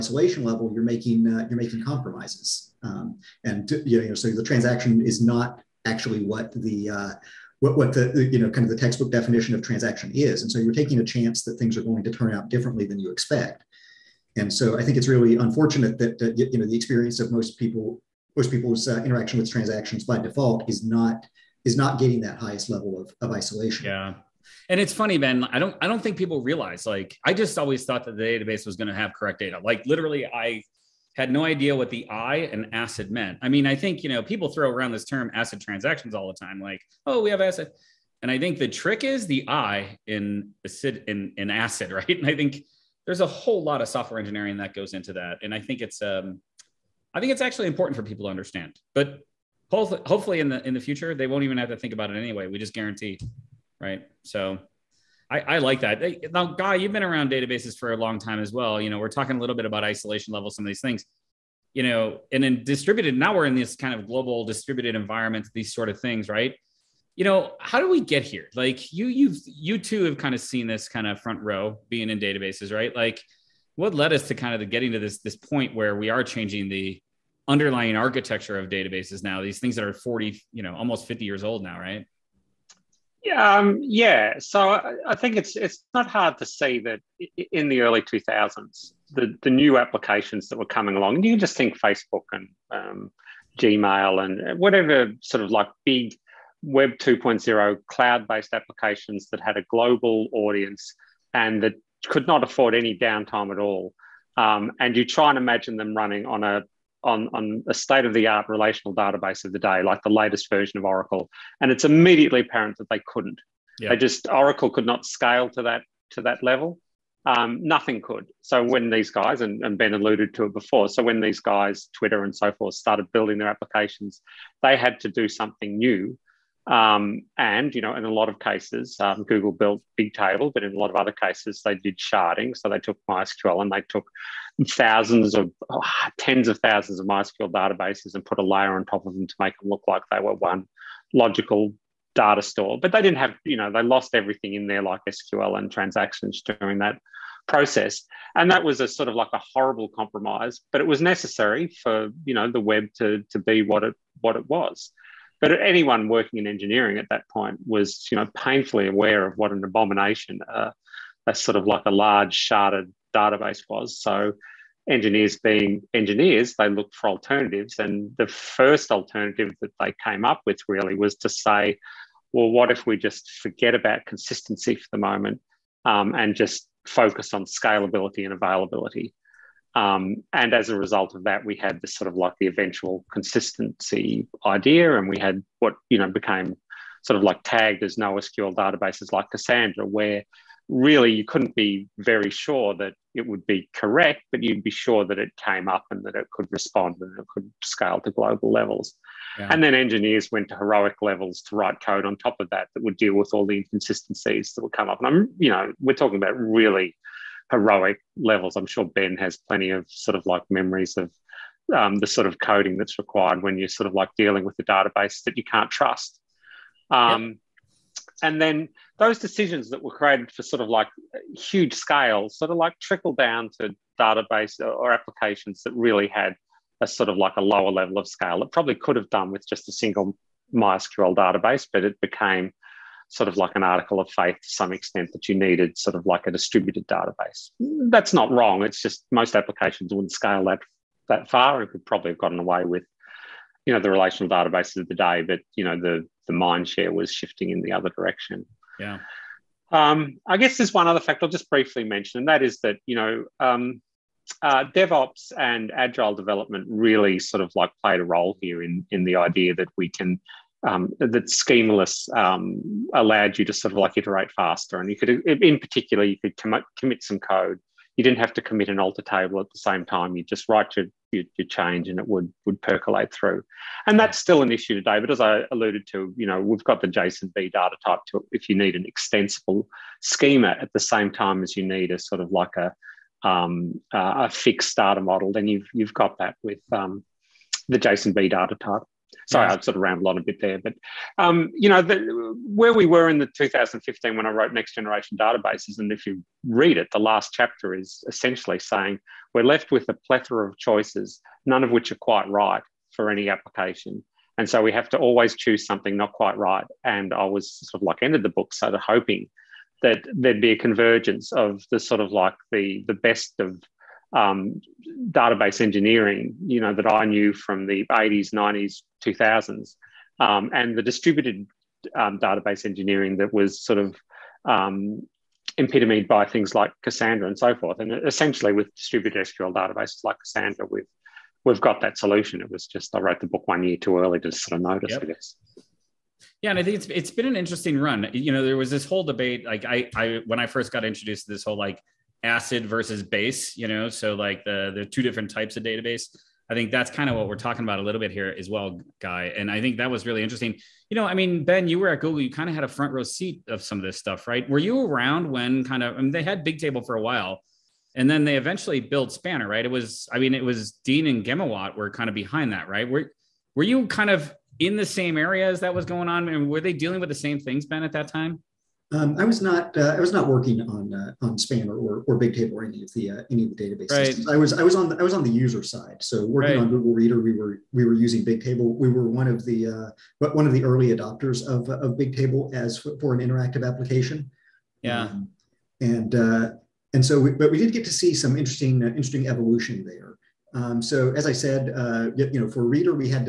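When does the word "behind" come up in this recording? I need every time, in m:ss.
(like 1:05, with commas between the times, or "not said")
6:02.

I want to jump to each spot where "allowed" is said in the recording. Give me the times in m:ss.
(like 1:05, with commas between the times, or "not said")
4:22.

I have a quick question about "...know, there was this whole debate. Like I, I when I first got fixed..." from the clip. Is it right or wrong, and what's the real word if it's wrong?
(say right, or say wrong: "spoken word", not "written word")
wrong: "introduced", not "fixed".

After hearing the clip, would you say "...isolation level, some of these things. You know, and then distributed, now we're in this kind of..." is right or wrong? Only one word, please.
right.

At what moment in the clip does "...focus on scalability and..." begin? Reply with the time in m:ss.
2:56.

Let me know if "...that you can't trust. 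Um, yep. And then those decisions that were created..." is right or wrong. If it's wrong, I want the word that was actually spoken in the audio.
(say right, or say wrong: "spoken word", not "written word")
right.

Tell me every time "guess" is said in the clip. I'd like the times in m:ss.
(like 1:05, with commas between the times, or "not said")
4:10, 5:35.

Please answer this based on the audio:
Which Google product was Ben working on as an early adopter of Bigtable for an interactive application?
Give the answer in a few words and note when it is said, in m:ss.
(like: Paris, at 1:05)
Google Reader, at 6:16.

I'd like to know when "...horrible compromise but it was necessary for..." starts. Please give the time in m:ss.
2:29.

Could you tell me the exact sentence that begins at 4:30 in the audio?
You just write your, your, your, change and it would, would percolate through.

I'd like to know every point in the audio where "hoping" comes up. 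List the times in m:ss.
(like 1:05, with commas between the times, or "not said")
5:08.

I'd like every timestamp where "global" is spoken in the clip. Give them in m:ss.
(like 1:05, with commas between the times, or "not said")
1:04, 1:39, 3:18.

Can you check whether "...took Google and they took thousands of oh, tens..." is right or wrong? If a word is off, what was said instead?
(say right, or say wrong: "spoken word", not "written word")
wrong: "MySQL", not "Google".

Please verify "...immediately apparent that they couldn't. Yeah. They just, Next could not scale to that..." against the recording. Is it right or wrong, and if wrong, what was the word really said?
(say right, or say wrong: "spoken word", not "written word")
wrong: "Oracle", not "Next".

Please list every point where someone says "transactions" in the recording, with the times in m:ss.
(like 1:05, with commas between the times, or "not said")
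0:04, 0:09, 0:19, 0:35, 2:25.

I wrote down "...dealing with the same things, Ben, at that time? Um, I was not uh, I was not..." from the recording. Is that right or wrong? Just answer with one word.
right.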